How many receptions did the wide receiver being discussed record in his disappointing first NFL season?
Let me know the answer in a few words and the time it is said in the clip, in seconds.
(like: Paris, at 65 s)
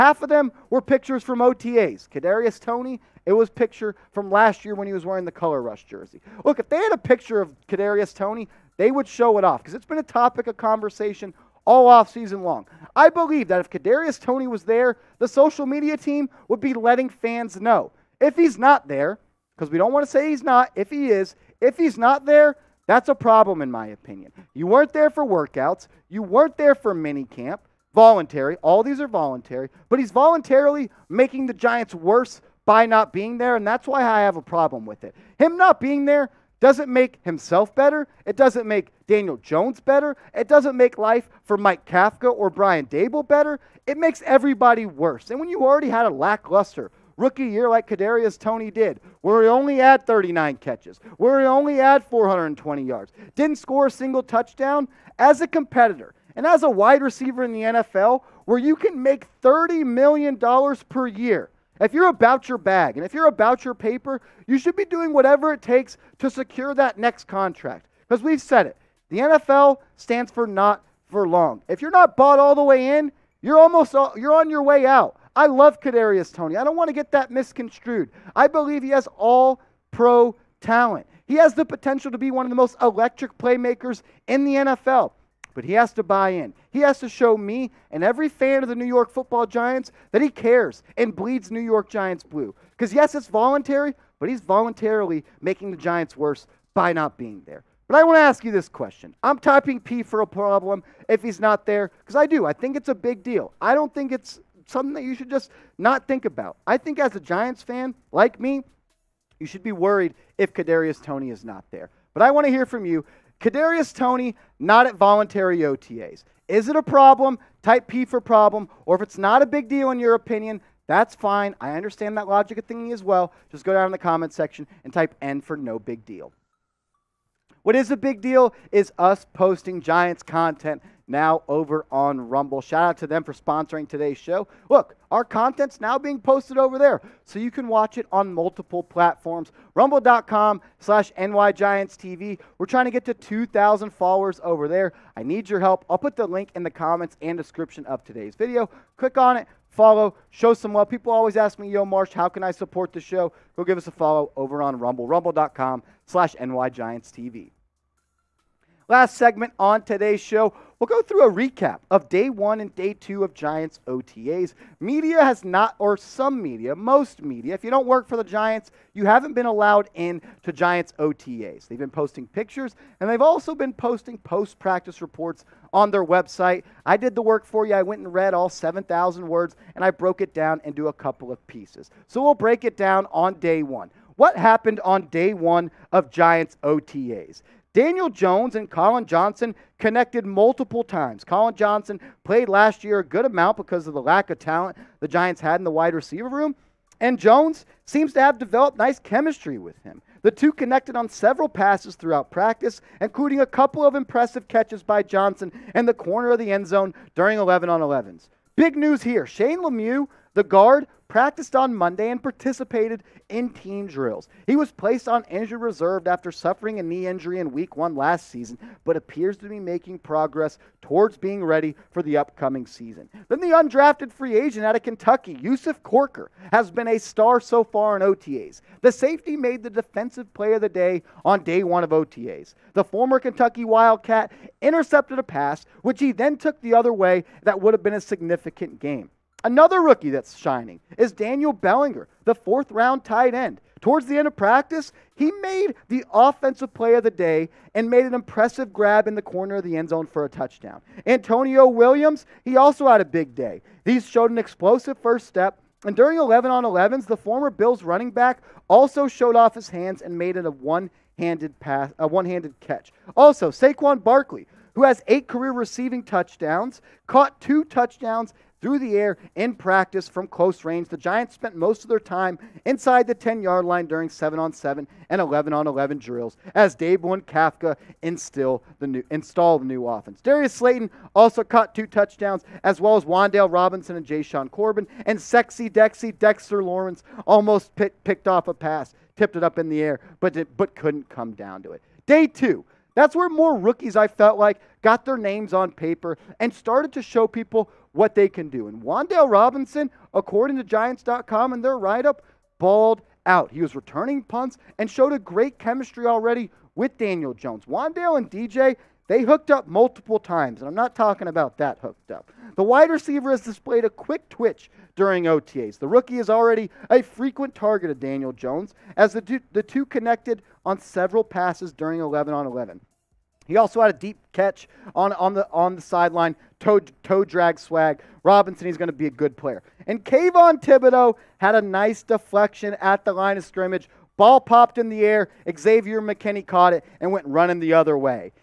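39, at 50 s.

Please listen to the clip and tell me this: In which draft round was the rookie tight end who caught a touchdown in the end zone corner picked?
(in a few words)
Fourth round.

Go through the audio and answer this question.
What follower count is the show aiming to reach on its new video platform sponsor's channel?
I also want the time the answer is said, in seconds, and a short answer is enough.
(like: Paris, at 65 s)
2,000, at 143 s.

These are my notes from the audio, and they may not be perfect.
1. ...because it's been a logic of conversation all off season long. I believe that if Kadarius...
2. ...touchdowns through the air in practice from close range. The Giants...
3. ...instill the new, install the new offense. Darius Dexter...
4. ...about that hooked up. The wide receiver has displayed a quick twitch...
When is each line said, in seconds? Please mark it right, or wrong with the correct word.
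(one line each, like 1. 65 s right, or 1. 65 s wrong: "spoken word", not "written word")
1. 9 s wrong: "topic", not "logic"
2. 267 s right
3. 278 s wrong: "Slayton", not "Dexter"
4. 311 s right.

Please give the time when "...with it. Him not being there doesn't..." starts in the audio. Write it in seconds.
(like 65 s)
34 s.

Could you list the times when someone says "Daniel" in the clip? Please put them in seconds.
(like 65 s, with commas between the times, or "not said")
39 s, 187 s, 241 s, 306 s, 317 s.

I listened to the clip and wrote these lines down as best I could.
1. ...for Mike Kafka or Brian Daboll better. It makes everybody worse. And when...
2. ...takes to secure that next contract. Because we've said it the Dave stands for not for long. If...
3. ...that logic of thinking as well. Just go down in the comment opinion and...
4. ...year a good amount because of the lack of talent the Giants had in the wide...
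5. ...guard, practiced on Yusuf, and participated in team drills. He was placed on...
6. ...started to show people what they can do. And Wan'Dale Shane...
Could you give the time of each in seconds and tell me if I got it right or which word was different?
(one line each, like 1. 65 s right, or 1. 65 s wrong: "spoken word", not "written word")
1. 41 s right
2. 65 s wrong: "NFL", not "Dave"
3. 122 s wrong: "section", not "opinion"
4. 192 s right
5. 210 s wrong: "Monday", not "Yusuf"
6. 296 s wrong: "Robinson", not "Shane".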